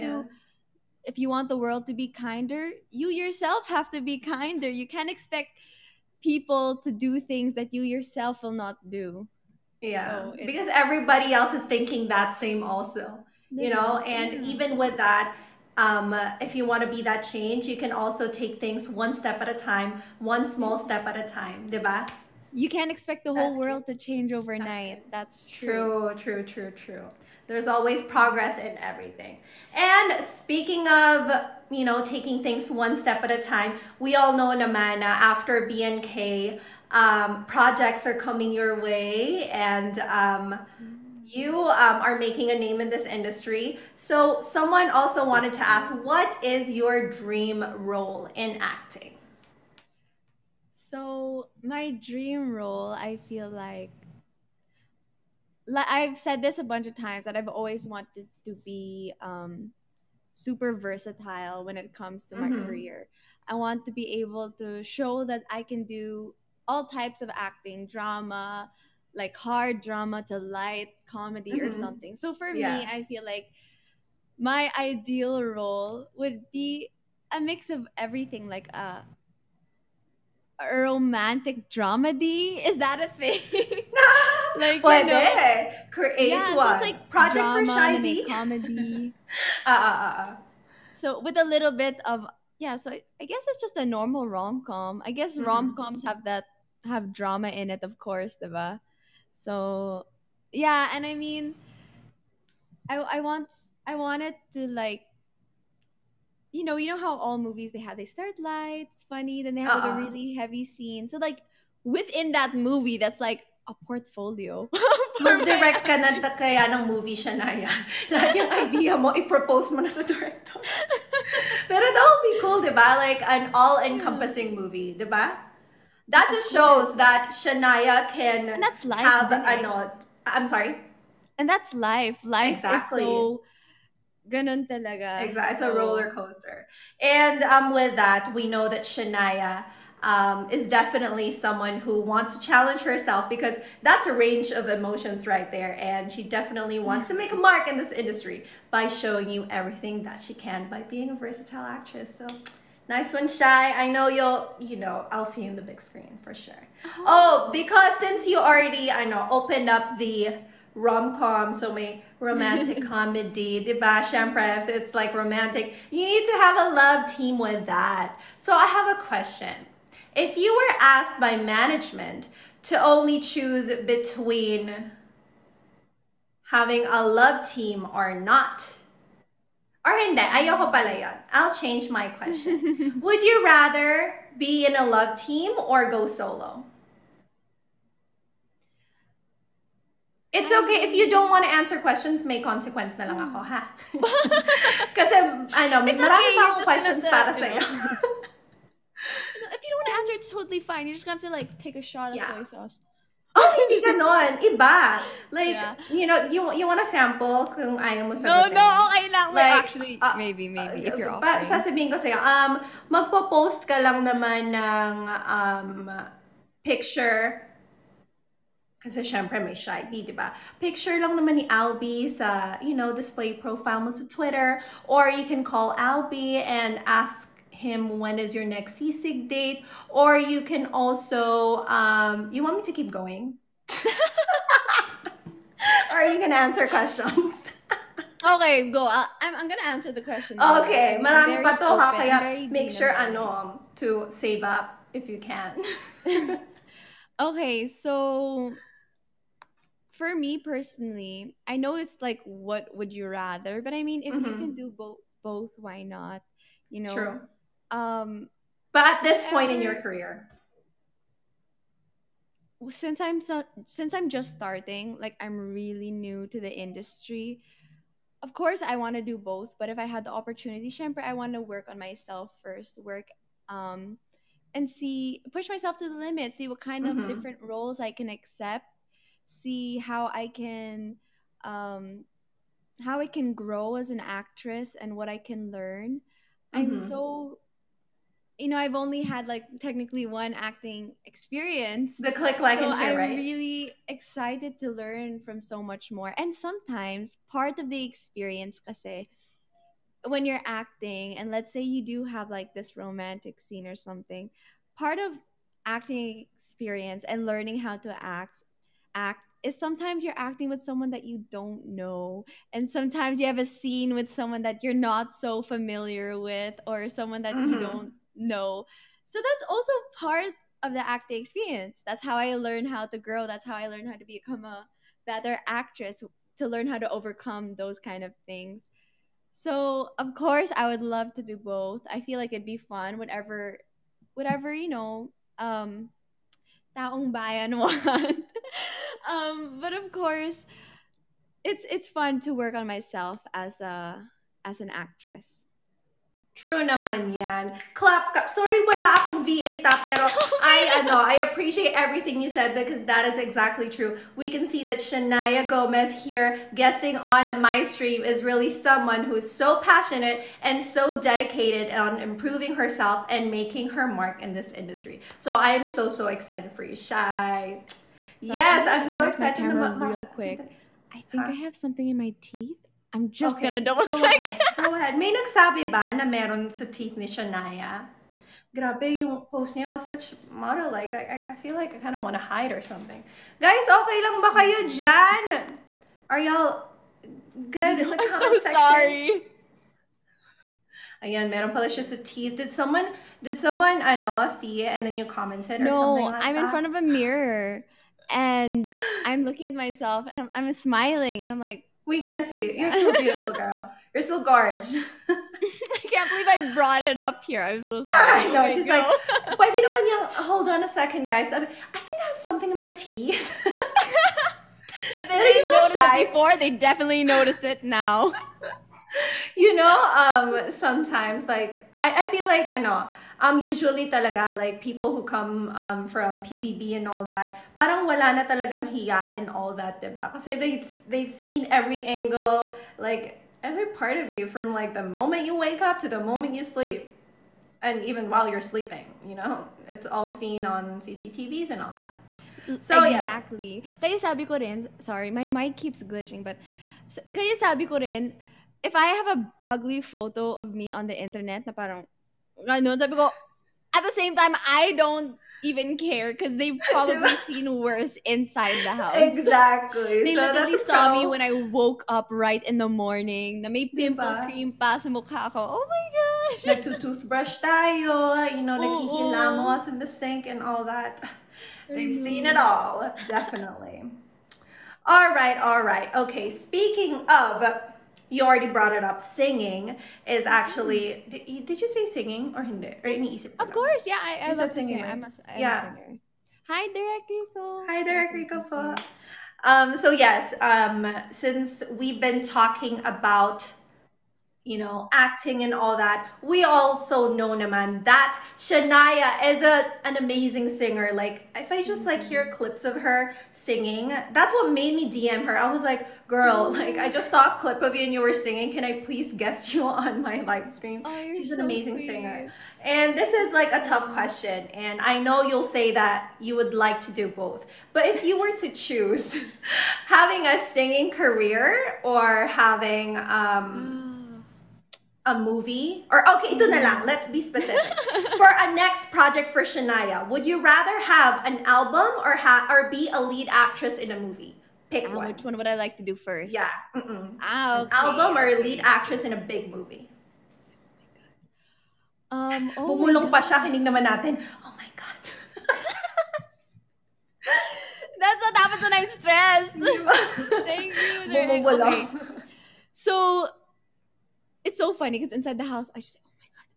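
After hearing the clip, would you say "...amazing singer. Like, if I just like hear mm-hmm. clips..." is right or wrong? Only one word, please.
right.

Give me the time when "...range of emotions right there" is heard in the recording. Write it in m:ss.
2:24.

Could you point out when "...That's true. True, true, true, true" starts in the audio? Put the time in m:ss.
0:25.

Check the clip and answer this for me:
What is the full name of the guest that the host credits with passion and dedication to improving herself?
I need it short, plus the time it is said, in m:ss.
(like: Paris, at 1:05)
Shanaia Gomez, at 5:54.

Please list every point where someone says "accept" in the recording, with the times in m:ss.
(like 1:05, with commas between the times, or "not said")
4:38.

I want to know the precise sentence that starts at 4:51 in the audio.
The click, like, so and share, I'm right?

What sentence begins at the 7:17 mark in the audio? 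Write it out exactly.
And even while you're sleeping, you know, it's all seen on CCTVs and all that.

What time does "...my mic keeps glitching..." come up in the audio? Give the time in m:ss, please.
7:25.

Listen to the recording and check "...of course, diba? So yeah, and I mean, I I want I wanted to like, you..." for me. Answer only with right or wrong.
right.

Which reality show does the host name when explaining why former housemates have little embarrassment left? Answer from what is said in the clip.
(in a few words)
PBB.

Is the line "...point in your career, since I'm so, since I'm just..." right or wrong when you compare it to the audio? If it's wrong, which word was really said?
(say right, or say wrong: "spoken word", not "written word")
right.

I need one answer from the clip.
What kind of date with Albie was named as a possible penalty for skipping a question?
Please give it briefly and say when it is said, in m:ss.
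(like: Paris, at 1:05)
seasick date, at 3:48.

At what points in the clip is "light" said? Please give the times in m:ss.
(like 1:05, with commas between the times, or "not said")
1:10, 1:48.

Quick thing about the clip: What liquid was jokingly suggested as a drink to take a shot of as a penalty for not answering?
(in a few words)
soy sauce.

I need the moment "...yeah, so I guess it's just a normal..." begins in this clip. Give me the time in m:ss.
1:32.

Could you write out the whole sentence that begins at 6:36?
in front of a mirror and I'm looking at myself and I'm, I'm smiling and I'm like, we can see you.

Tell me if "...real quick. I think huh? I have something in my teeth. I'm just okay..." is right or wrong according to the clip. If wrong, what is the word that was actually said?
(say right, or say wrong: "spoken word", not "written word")
right.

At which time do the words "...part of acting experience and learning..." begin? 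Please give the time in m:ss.
5:04.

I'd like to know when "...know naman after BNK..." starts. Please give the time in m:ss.
0:34.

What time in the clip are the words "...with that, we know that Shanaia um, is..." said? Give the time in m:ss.
2:17.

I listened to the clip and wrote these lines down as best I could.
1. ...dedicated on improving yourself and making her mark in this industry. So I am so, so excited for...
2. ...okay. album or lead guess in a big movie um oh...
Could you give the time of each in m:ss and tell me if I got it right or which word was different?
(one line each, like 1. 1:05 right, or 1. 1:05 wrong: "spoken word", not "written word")
1. 6:01 wrong: "herself", not "yourself"
2. 8:57 wrong: "actress", not "guess".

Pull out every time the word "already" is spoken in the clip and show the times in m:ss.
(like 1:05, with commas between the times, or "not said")
2:38, 7:58.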